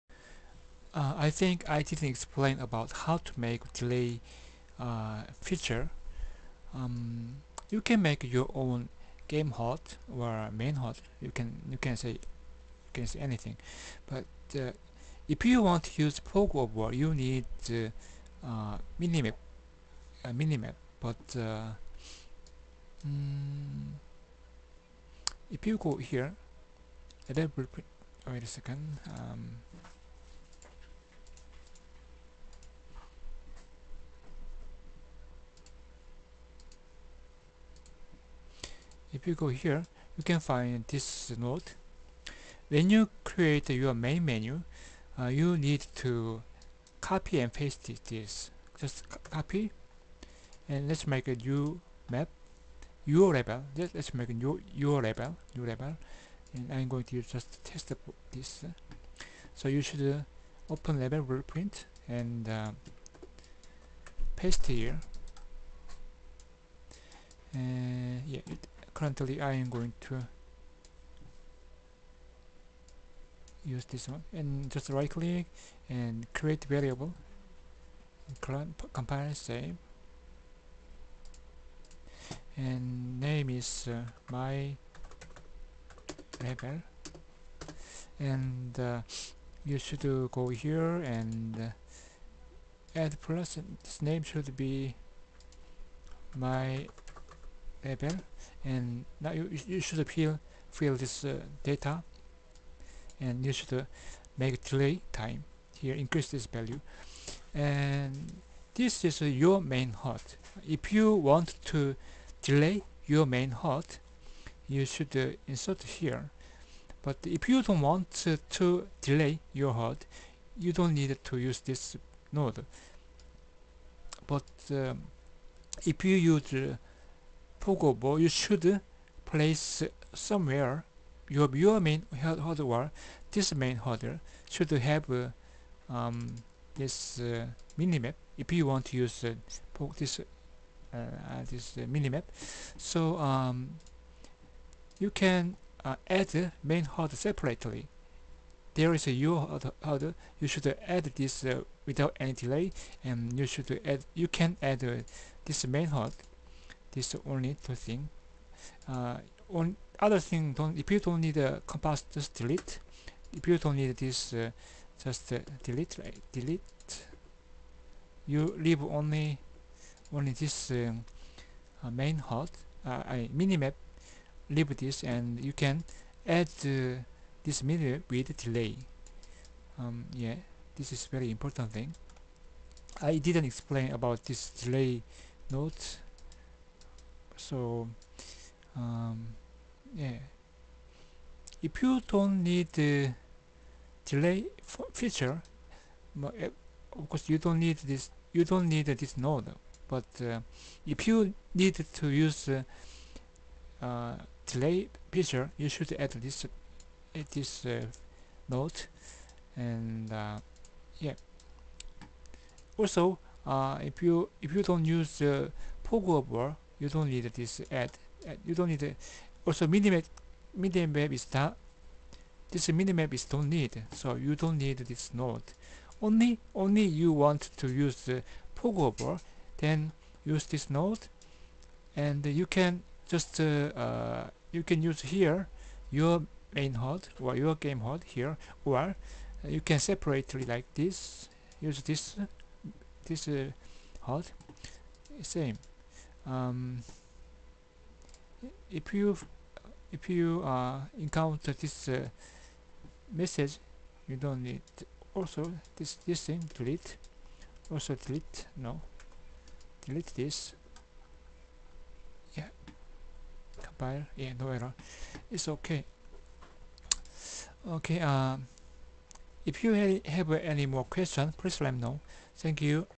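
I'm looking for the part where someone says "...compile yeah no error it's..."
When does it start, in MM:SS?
04:23.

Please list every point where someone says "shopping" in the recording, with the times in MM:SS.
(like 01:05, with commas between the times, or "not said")
not said.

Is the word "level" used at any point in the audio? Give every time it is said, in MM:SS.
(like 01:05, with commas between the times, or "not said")
00:53, 01:00.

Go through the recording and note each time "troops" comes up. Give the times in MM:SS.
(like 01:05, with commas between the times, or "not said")
not said.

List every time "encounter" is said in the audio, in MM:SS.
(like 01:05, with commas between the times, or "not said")
04:10.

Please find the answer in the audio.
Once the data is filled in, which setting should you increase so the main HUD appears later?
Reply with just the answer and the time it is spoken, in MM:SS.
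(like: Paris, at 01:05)
Delay time, at 01:44.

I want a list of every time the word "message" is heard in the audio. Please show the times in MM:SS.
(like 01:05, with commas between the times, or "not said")
04:13.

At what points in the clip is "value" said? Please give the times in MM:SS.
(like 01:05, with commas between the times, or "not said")
01:46.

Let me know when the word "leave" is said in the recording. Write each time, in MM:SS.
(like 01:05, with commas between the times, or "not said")
02:48, 02:54.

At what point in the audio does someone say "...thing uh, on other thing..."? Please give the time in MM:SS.
02:37.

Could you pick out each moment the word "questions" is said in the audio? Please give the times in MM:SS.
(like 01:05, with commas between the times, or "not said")
04:30.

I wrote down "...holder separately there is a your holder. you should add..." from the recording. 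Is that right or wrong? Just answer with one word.
right.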